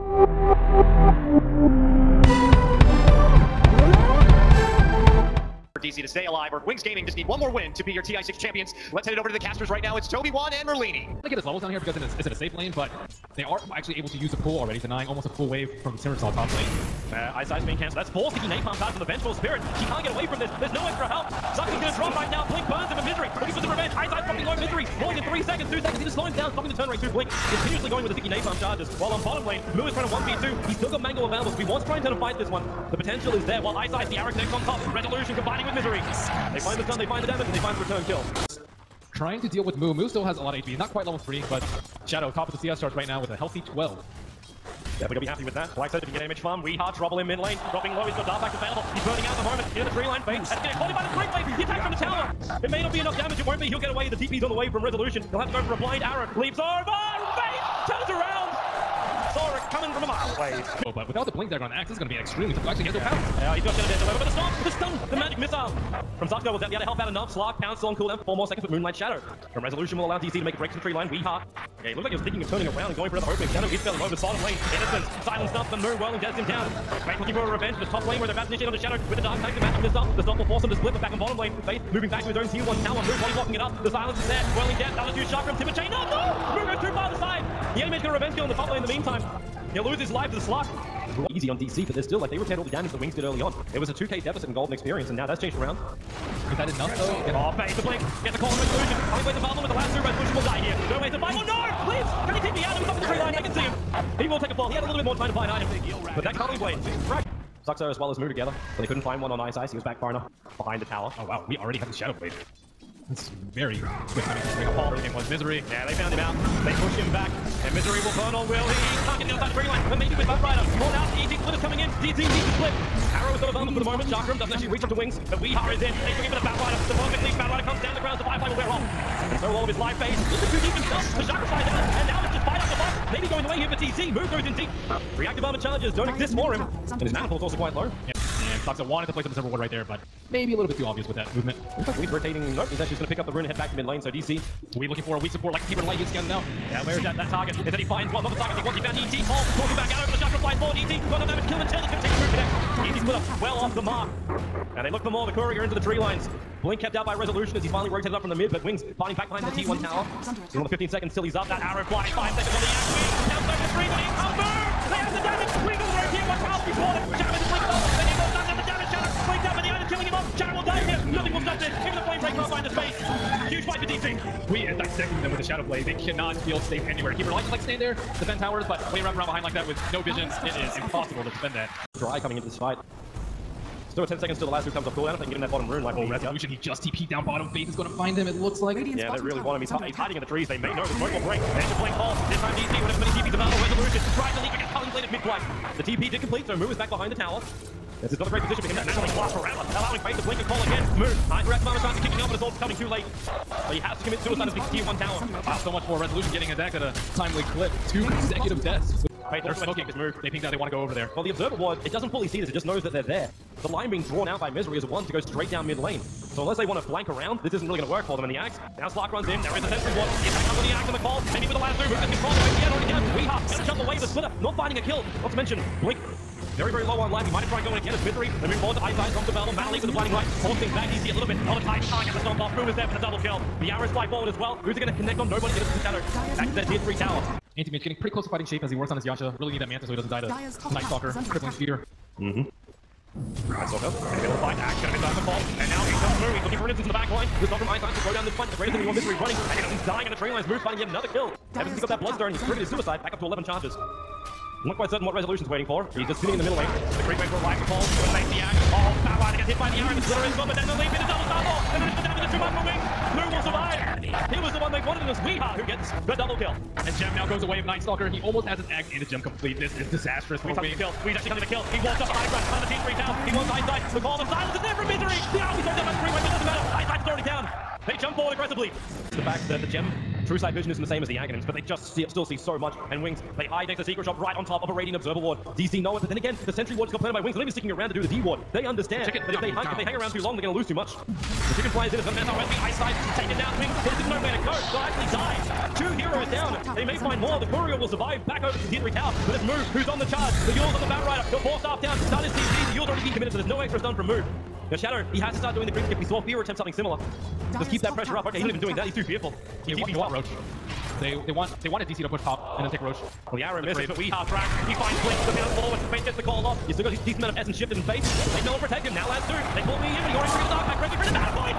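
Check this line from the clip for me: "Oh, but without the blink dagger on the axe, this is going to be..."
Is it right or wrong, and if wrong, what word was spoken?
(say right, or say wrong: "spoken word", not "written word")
right.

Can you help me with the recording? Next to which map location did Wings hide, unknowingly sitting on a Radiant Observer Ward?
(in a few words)
Secret Shop.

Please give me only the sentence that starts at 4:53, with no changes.
But it's didn't know where to go.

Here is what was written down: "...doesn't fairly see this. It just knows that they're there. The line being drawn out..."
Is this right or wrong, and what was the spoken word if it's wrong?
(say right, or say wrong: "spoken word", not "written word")
wrong: "fully", not "fairly".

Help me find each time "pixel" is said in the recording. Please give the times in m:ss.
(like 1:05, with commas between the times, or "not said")
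not said.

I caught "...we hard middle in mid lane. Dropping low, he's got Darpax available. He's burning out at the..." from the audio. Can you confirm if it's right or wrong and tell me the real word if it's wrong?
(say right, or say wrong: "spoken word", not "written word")
wrong: "trouble", not "middle".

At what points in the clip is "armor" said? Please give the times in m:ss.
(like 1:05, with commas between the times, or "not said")
2:15.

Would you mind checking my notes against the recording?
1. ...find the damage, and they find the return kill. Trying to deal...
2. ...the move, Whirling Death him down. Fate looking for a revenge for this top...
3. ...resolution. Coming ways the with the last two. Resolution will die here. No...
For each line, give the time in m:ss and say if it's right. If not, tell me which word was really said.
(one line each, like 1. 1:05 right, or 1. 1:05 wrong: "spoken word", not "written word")
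1. 0:37 right
2. 1:15 right
3. 1:38 right.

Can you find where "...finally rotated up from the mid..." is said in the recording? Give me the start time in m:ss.
2:37.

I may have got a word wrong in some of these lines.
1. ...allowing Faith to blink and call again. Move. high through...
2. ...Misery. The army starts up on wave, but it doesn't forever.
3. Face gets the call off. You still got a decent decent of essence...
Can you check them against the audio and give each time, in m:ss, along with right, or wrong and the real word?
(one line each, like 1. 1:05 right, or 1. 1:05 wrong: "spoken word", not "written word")
1. 3:19 right
2. 4:34 wrong: "matter", not "forever"
3. 5:15 wrong: "amount", not "decent".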